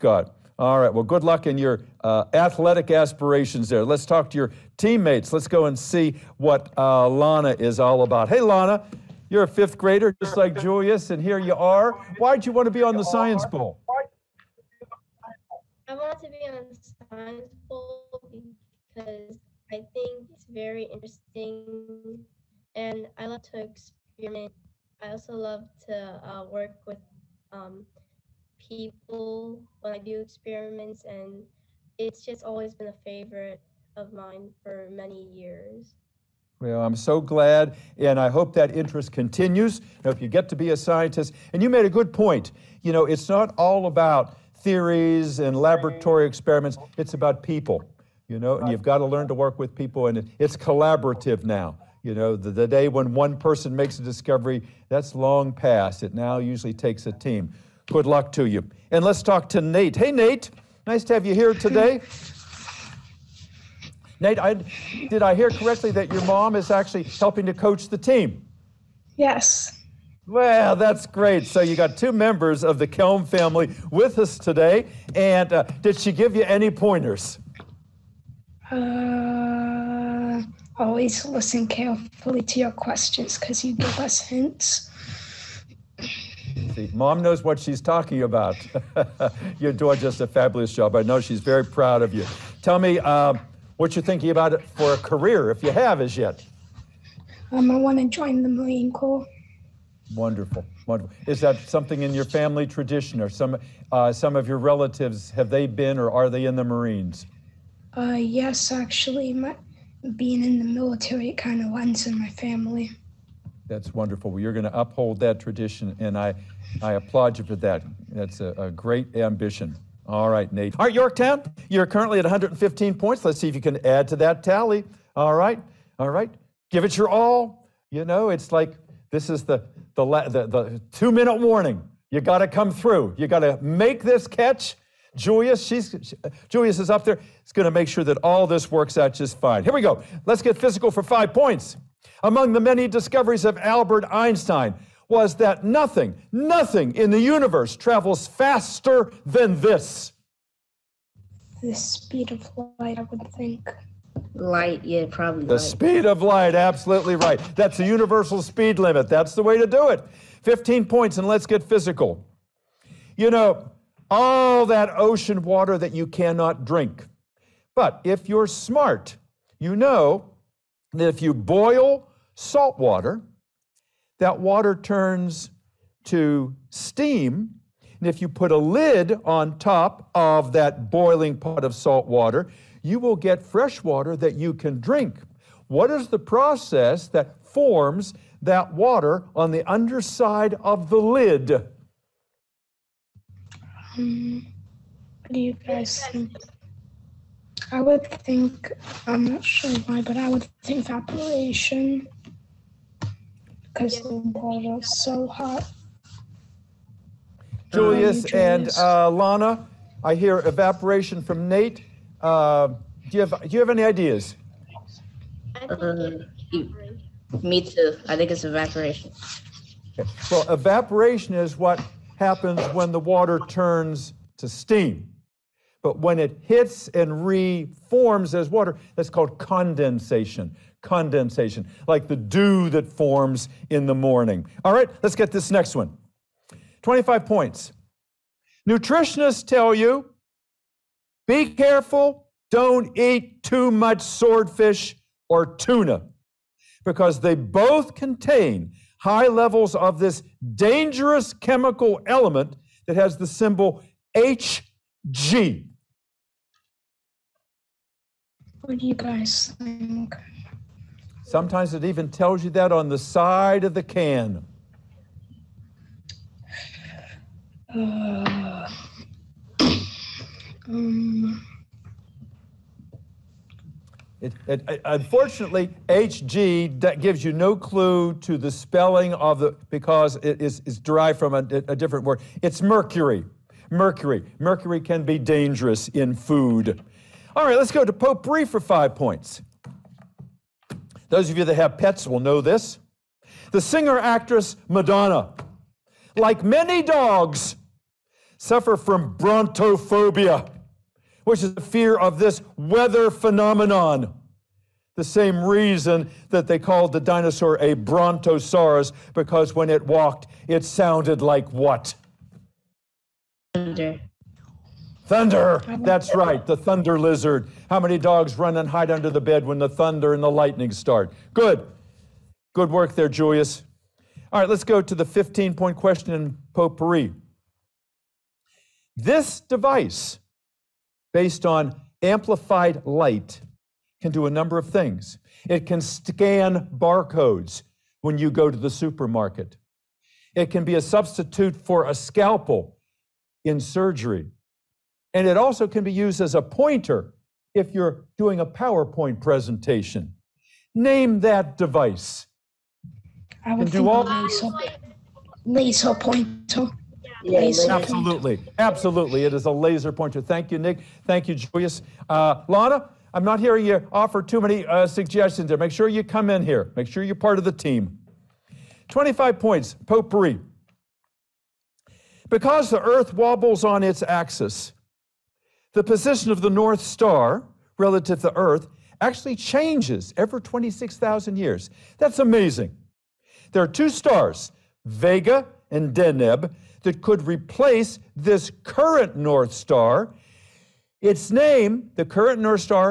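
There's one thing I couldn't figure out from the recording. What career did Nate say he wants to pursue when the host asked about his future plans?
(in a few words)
Marine Corps.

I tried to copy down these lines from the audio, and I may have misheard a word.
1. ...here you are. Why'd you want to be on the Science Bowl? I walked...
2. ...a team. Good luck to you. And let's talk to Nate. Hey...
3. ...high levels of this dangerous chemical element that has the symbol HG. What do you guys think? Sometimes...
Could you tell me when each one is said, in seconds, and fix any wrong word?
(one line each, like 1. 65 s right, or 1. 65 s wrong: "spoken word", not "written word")
1. 11 s wrong: "wanted", not "walked"
2. 57 s right
3. 249 s right.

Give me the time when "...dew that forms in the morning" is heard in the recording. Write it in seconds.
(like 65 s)
232 s.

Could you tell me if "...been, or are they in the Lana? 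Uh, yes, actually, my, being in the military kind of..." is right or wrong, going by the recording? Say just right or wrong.
wrong.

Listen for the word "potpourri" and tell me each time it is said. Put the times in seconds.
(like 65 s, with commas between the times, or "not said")
287 s, 326 s, 369 s.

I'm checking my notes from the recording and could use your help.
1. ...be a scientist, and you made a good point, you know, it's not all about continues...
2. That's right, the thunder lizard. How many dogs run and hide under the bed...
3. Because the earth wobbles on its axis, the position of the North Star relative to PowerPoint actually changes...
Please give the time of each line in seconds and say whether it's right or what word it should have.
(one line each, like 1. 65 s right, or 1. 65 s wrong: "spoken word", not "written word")
1. 40 s wrong: "theories", not "continues"
2. 315 s right
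3. 372 s wrong: "Earth", not "PowerPoint".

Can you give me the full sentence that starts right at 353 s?
I would and all laser, laser pointer.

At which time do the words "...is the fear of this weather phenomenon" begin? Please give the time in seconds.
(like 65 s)
301 s.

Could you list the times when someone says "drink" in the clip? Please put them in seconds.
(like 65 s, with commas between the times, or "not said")
166 s, 184 s.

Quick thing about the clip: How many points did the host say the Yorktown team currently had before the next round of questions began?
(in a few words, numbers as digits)
115.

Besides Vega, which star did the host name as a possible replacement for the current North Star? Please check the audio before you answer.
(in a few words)
Deneb.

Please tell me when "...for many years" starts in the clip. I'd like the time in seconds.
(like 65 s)
34 s.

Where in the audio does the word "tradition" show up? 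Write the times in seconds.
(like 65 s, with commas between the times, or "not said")
102 s, 115 s.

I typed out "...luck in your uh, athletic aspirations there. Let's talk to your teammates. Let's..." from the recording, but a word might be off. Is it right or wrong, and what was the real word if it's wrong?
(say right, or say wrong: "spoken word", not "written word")
right.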